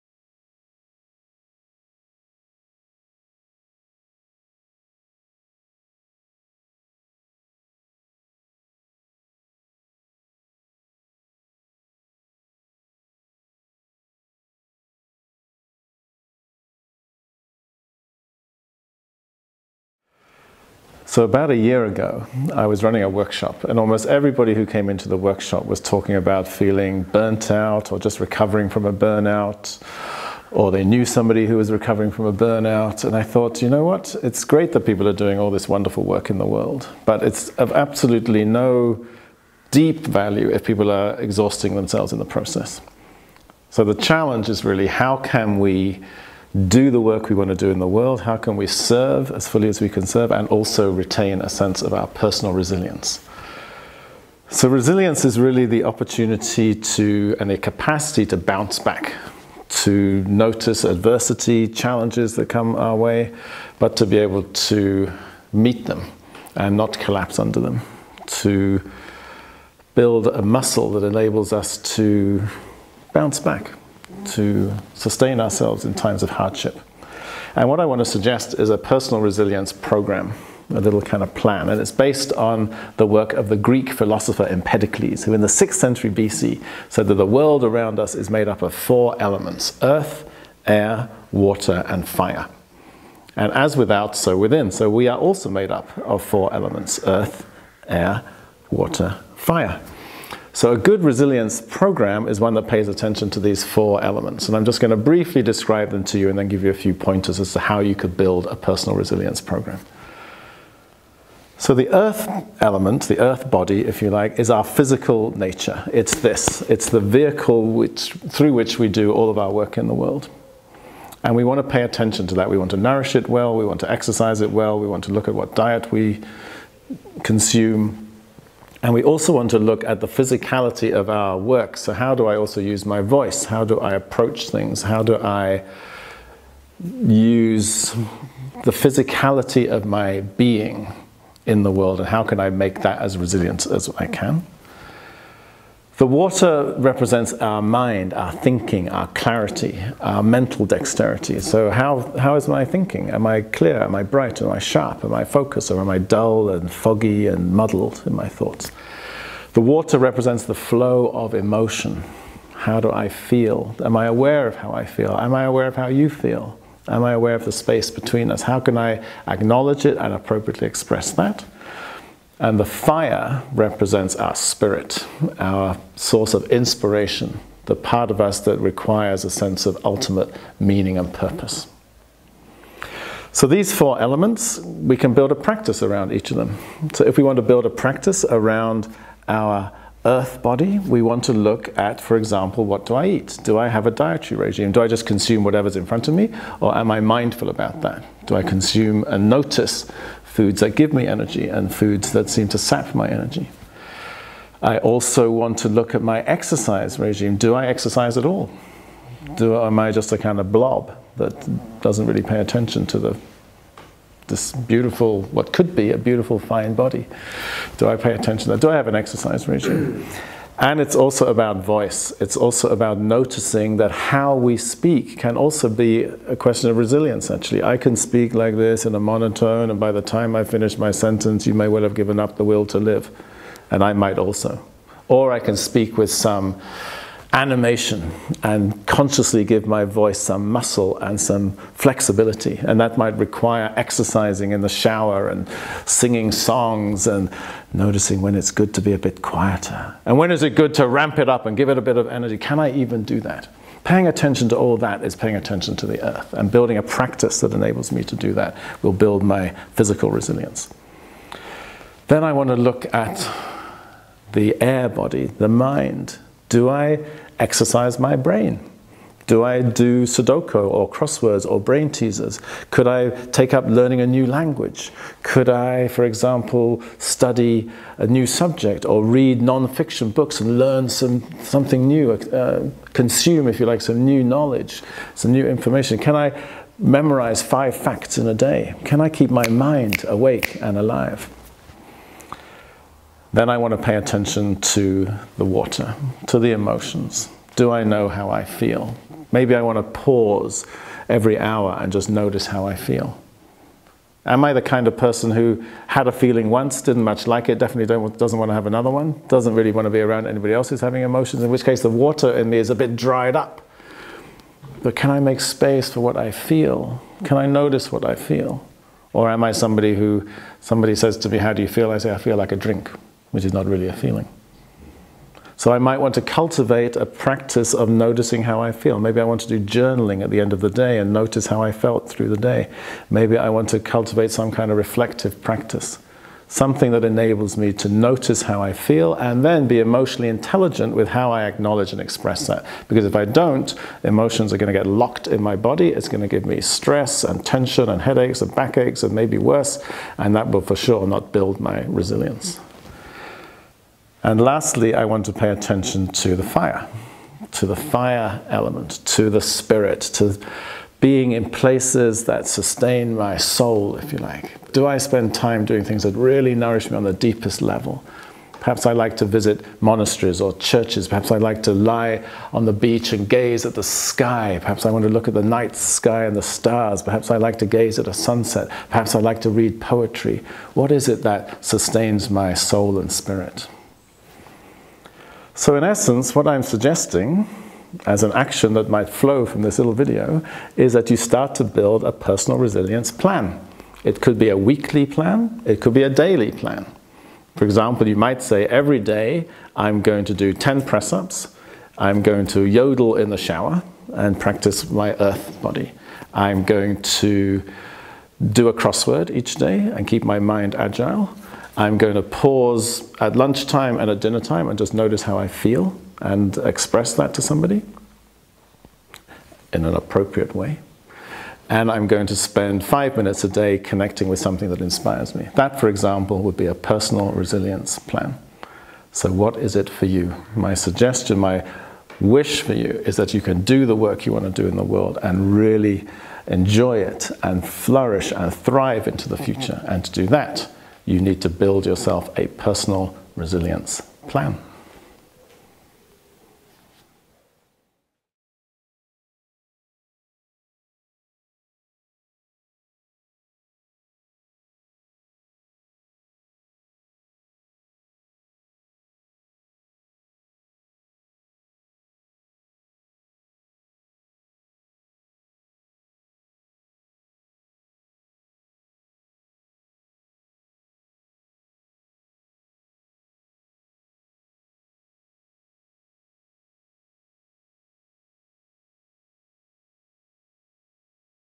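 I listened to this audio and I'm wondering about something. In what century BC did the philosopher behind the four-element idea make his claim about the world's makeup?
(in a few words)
6th century.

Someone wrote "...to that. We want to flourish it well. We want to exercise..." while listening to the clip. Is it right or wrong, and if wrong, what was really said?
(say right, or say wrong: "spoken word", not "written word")
wrong: "nourish", not "flourish".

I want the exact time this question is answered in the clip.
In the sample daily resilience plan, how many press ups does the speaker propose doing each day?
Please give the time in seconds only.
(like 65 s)
400 s.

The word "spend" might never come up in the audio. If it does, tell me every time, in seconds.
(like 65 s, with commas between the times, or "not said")
364 s, 422 s.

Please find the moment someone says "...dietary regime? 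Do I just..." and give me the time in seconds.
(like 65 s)
193 s.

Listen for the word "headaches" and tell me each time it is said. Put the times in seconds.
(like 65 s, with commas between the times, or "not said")
348 s.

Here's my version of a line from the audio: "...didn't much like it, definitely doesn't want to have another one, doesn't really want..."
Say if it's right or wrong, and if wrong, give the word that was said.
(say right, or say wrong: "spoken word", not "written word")
right.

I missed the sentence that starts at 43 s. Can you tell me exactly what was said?
So the challenge is really how can we do the work we want to do in the world?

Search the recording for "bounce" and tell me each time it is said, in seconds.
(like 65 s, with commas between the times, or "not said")
58 s, 73 s.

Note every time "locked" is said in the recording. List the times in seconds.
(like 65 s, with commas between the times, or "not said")
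344 s.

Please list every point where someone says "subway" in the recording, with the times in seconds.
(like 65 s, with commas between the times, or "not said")
not said.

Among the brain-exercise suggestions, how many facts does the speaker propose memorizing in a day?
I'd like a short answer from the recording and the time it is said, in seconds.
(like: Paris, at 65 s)
5, at 287 s.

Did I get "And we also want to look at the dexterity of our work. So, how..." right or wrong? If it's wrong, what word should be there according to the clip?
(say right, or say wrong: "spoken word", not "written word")
wrong: "physicality", not "dexterity".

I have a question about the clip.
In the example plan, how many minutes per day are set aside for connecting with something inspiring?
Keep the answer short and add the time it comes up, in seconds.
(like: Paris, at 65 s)
5, at 422 s.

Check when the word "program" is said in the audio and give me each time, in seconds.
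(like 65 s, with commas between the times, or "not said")
79 s, 101 s, 109 s.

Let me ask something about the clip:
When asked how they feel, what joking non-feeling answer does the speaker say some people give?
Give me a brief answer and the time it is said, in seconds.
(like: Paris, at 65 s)
I feel like a drink, at 322 s.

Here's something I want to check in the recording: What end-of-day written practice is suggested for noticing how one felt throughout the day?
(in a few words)
Journaling.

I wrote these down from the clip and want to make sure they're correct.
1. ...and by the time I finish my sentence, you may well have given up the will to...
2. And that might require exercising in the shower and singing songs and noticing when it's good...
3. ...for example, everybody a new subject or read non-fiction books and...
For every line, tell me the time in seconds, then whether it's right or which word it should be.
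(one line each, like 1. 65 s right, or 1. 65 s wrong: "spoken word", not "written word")
1. 229 s right
2. 242 s right
3. 275 s wrong: "study", not "everybody".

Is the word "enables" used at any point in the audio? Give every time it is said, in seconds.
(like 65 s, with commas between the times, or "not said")
71 s, 257 s, 337 s.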